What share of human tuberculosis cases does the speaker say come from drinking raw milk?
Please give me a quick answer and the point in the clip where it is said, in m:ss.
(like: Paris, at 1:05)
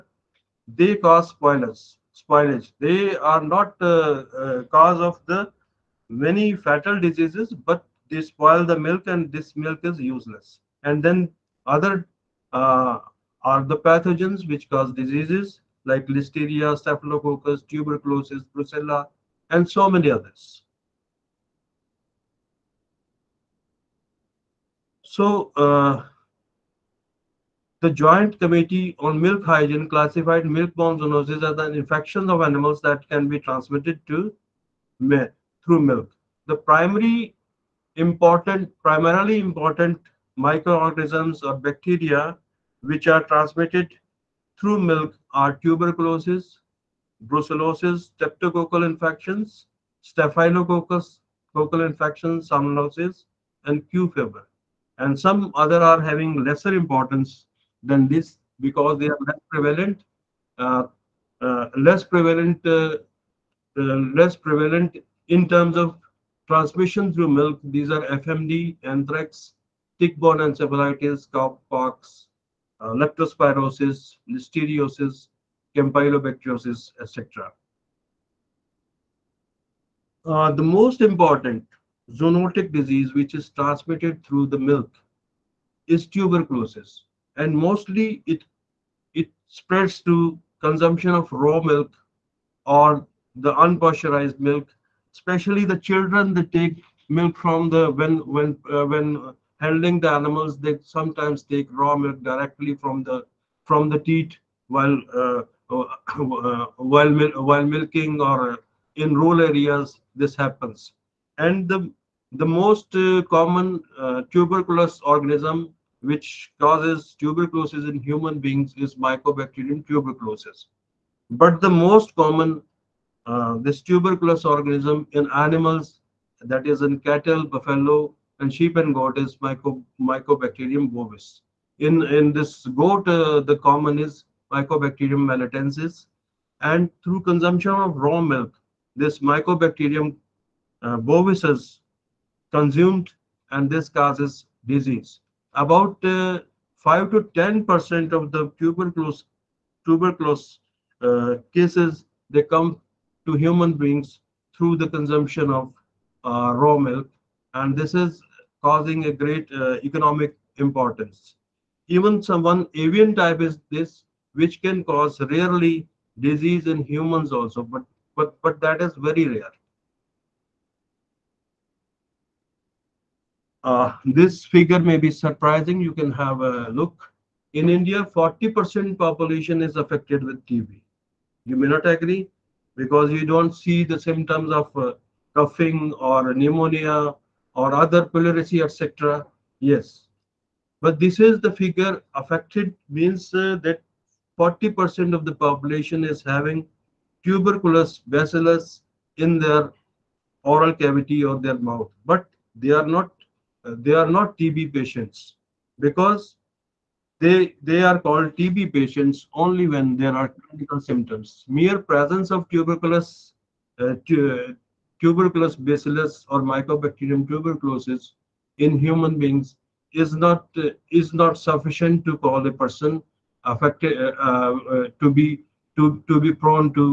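5 to 10%, at 2:26.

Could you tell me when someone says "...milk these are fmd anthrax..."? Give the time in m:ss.
1:07.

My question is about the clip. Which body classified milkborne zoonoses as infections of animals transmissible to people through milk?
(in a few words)
Joint Committee on Milk Hygiene.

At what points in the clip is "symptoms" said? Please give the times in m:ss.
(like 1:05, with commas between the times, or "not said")
3:03, 3:30.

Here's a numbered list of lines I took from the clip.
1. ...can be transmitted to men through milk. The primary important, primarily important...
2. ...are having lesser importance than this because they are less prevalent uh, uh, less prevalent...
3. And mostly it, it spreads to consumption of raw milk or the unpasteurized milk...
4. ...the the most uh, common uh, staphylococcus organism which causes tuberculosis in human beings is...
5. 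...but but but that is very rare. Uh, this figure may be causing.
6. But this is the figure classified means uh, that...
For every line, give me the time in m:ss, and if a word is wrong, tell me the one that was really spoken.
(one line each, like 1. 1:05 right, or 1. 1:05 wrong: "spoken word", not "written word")
1. 0:33 right
2. 0:55 right
3. 1:27 right
4. 1:51 wrong: "tuberculous", not "staphylococcus"
5. 2:47 wrong: "surprising", not "causing"
6. 3:10 wrong: "affected", not "classified".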